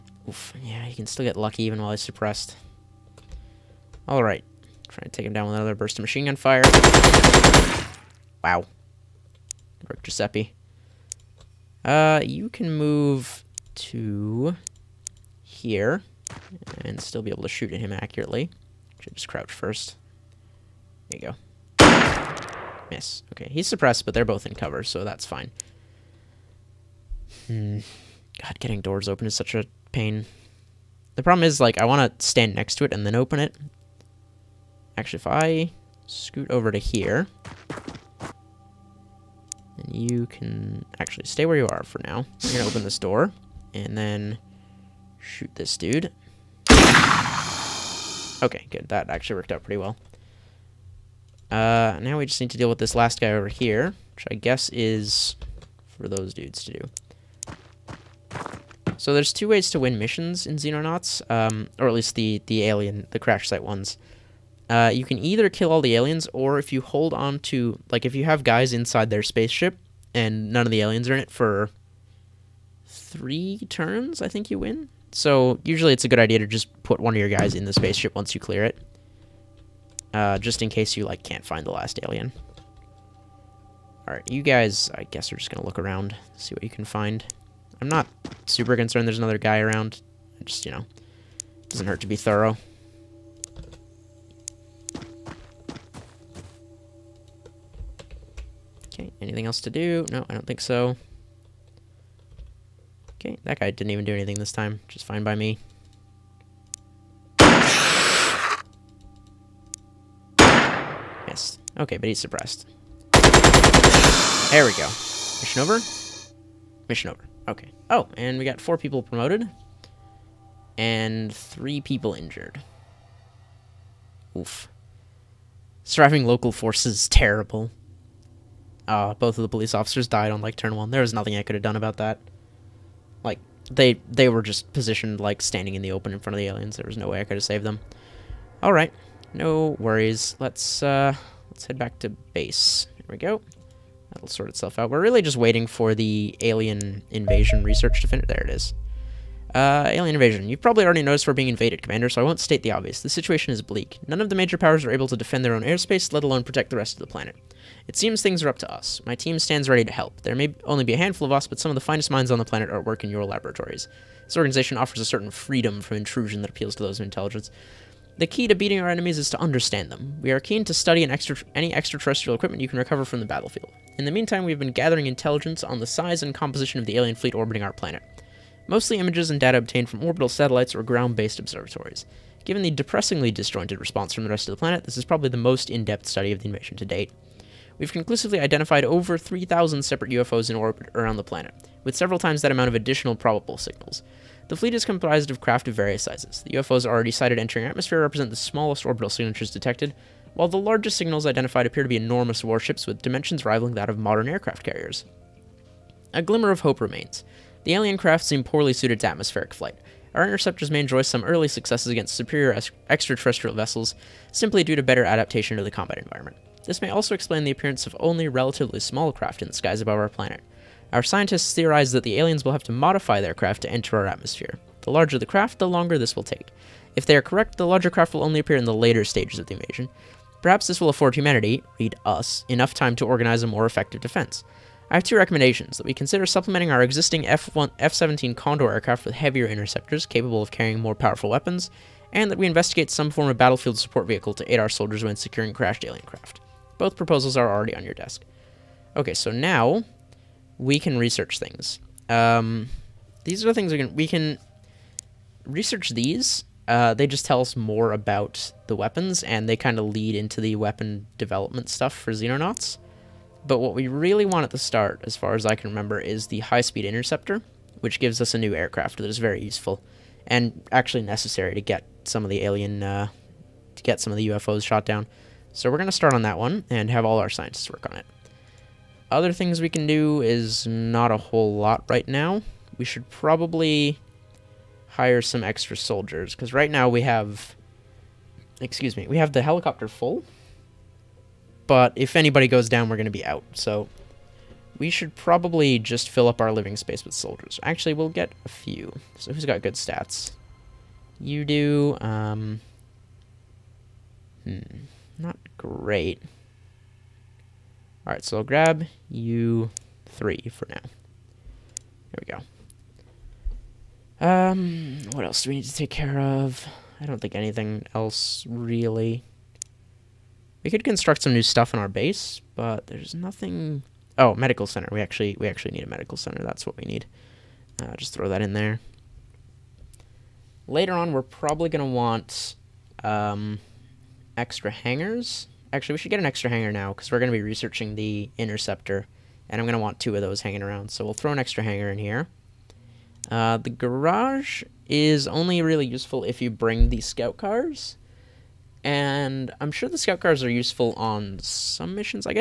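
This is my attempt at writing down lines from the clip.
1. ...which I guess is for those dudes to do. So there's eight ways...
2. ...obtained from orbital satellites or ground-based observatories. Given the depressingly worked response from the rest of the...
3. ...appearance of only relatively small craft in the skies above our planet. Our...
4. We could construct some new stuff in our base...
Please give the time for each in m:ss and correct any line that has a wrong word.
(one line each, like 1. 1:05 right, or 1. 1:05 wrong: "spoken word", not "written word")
1. 0:54 wrong: "two", not "eight"
2. 2:59 wrong: "disjointed", not "worked"
3. 3:37 right
4. 5:20 right.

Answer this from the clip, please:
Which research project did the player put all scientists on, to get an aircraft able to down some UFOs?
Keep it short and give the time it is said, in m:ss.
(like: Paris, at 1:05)
High-speed interceptor, at 4:26.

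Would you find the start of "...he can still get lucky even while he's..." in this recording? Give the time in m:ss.
0:00.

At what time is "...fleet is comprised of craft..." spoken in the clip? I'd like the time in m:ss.
3:14.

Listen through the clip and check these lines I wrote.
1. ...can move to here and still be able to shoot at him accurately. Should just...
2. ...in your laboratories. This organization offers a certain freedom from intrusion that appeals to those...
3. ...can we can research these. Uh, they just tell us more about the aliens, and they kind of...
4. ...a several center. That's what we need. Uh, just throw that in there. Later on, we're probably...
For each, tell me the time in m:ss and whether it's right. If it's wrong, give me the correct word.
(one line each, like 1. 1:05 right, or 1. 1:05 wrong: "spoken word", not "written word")
1. 0:12 right
2. 2:43 right
3. 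4:13 wrong: "weapons", not "aliens"
4. 5:25 wrong: "medical", not "several".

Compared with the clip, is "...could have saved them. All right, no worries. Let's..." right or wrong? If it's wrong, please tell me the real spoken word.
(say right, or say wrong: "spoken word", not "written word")
right.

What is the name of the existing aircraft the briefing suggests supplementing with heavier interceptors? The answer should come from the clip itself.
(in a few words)
F-17 Condor.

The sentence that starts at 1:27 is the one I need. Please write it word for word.
I'm not super concerned there's another guy around.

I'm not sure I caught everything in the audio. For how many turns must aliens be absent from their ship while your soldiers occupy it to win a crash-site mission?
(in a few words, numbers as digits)
3.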